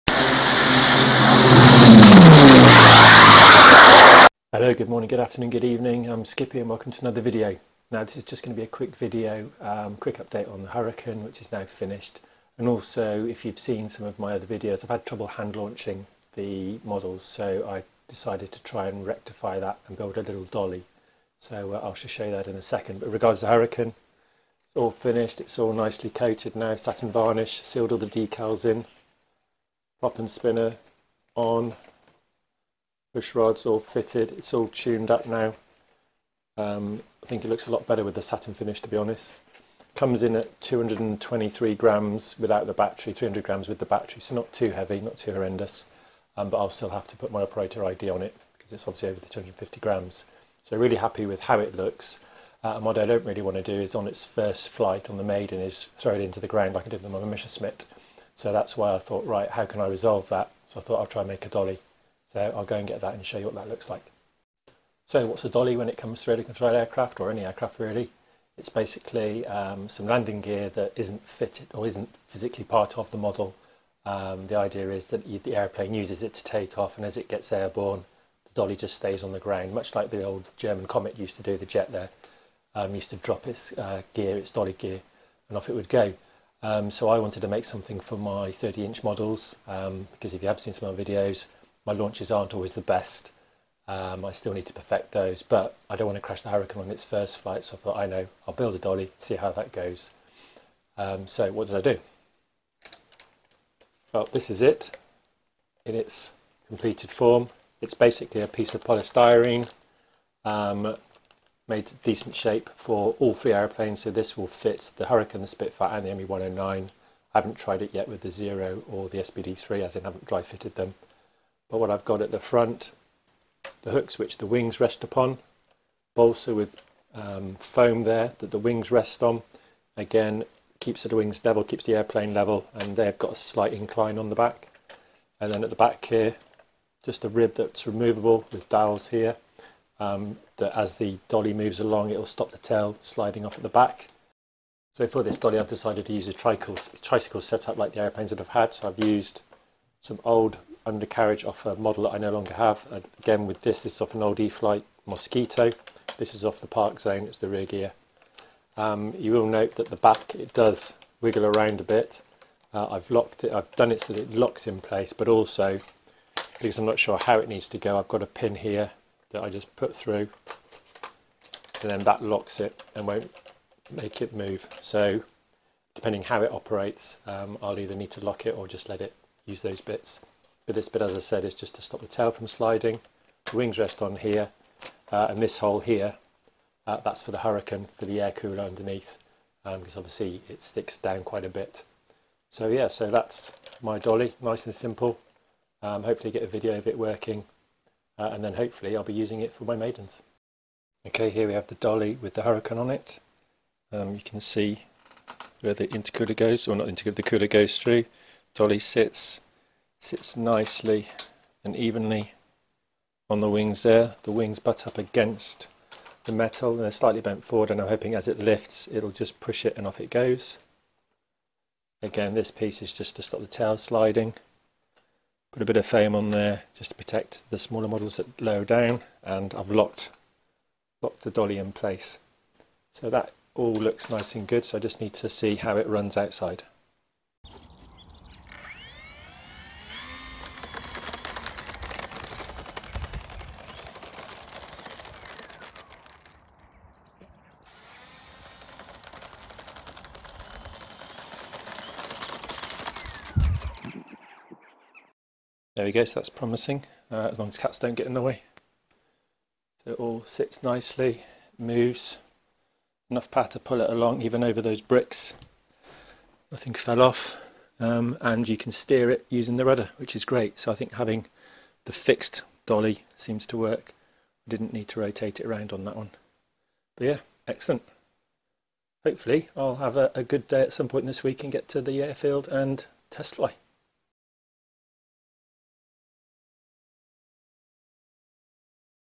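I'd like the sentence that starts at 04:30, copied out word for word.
So I think having the fixed dolly seems to work.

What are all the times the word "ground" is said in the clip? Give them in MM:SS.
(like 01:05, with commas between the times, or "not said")
00:56, 01:19.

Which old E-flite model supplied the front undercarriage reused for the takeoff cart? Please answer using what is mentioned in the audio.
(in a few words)
Mosquito.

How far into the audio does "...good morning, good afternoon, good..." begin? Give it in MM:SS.
00:04.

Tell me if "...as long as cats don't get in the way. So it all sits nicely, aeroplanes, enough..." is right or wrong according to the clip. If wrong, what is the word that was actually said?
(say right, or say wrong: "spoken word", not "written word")
wrong: "moves", not "aeroplanes".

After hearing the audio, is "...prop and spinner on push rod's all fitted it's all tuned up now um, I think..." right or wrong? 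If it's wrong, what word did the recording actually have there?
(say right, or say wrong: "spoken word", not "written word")
right.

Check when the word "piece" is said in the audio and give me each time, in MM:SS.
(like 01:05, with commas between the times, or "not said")
01:48, 03:42.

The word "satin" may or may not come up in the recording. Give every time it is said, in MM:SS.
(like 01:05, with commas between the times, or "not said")
00:26, 00:38.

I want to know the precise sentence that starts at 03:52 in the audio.
So that all looks nice and good so I just need to see how it runs outside.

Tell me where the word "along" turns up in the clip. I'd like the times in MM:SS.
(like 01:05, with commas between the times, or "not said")
02:21, 04:23.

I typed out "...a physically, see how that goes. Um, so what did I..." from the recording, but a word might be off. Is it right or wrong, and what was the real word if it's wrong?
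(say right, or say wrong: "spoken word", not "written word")
wrong: "dolly", not "physically".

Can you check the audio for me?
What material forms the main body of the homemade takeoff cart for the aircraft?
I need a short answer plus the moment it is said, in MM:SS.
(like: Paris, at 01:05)
polystyrene, at 01:48.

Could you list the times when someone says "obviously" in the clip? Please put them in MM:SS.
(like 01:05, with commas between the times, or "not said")
00:48, 03:10.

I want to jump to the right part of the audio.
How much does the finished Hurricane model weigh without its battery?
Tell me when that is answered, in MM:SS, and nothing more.
00:40.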